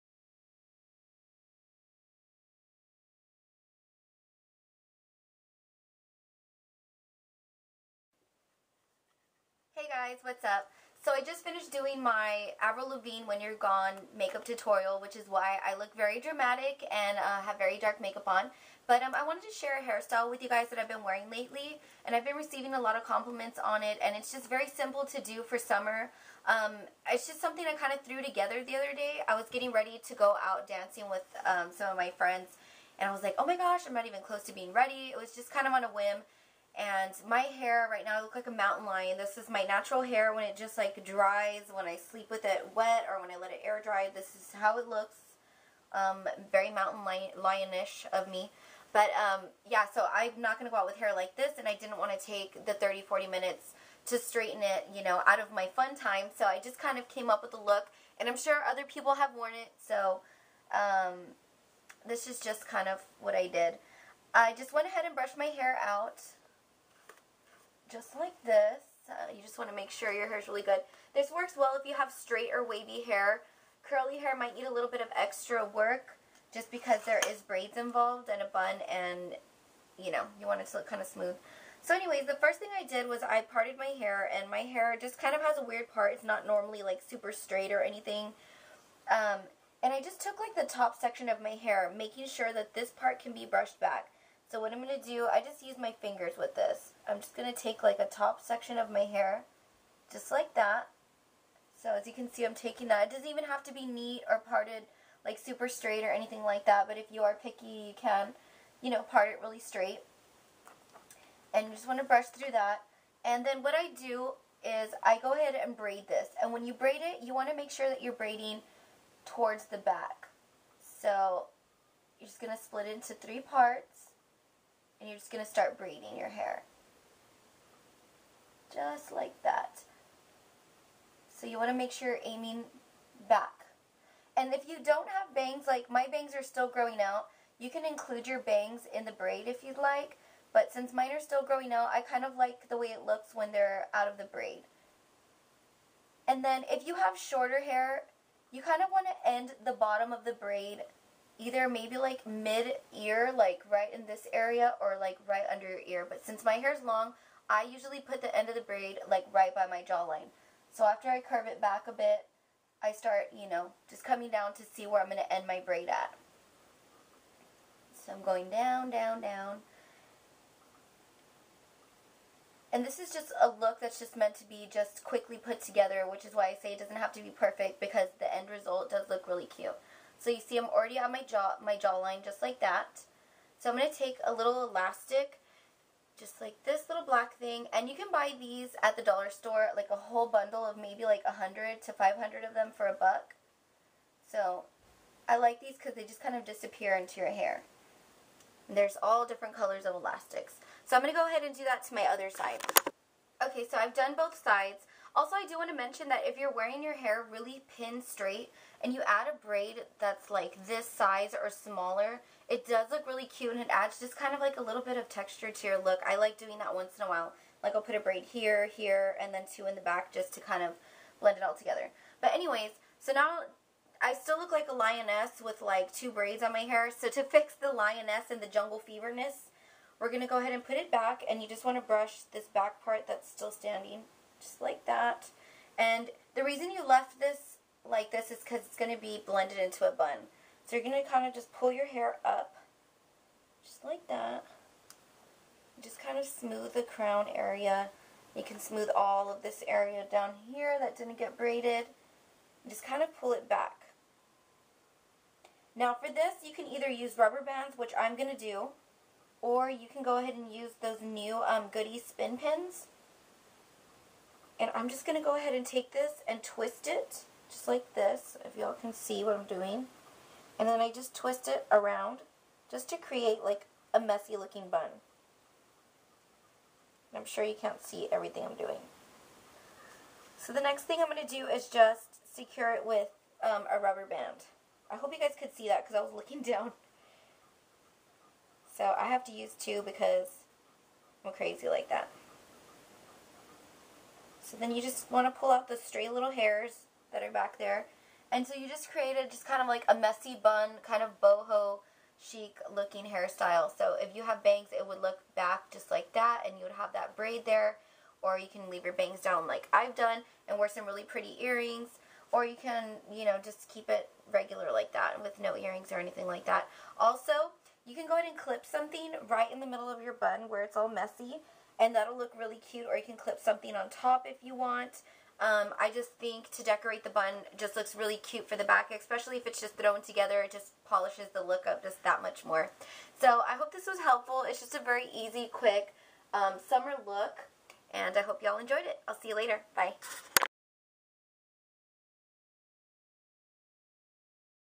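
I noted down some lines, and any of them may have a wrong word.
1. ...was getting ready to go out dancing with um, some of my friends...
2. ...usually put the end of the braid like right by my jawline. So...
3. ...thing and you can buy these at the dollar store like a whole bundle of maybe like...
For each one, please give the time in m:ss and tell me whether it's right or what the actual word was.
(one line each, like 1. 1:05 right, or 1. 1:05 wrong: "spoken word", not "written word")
1. 0:29 right
2. 2:37 right
3. 3:07 right.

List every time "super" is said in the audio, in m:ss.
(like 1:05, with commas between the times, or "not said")
1:27, 1:45.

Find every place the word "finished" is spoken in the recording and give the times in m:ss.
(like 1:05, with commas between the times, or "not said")
0:11.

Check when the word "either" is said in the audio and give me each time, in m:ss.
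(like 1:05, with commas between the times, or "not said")
2:31, 4:16.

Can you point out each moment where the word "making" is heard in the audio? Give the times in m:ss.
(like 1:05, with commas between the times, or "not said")
1:31.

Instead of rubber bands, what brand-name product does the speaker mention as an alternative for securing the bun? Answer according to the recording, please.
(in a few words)
Goody spin pins.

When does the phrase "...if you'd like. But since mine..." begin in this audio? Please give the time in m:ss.
2:19.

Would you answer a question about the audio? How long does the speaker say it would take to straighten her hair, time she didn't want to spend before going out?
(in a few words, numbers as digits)
30, 40 minutes.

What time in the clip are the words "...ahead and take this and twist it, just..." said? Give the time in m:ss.
4:25.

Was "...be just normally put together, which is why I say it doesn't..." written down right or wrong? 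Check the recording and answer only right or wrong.
wrong.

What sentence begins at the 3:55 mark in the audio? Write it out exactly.
And the reason you left this like this is because it's going to be blended into a bun.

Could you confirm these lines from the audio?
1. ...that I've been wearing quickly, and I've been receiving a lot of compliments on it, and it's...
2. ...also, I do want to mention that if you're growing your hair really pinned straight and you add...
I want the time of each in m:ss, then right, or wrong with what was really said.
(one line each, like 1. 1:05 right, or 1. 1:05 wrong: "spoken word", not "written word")
1. 0:20 wrong: "lately", not "quickly"
2. 3:25 wrong: "wearing", not "growing".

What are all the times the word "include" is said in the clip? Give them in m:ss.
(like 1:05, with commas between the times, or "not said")
2:17.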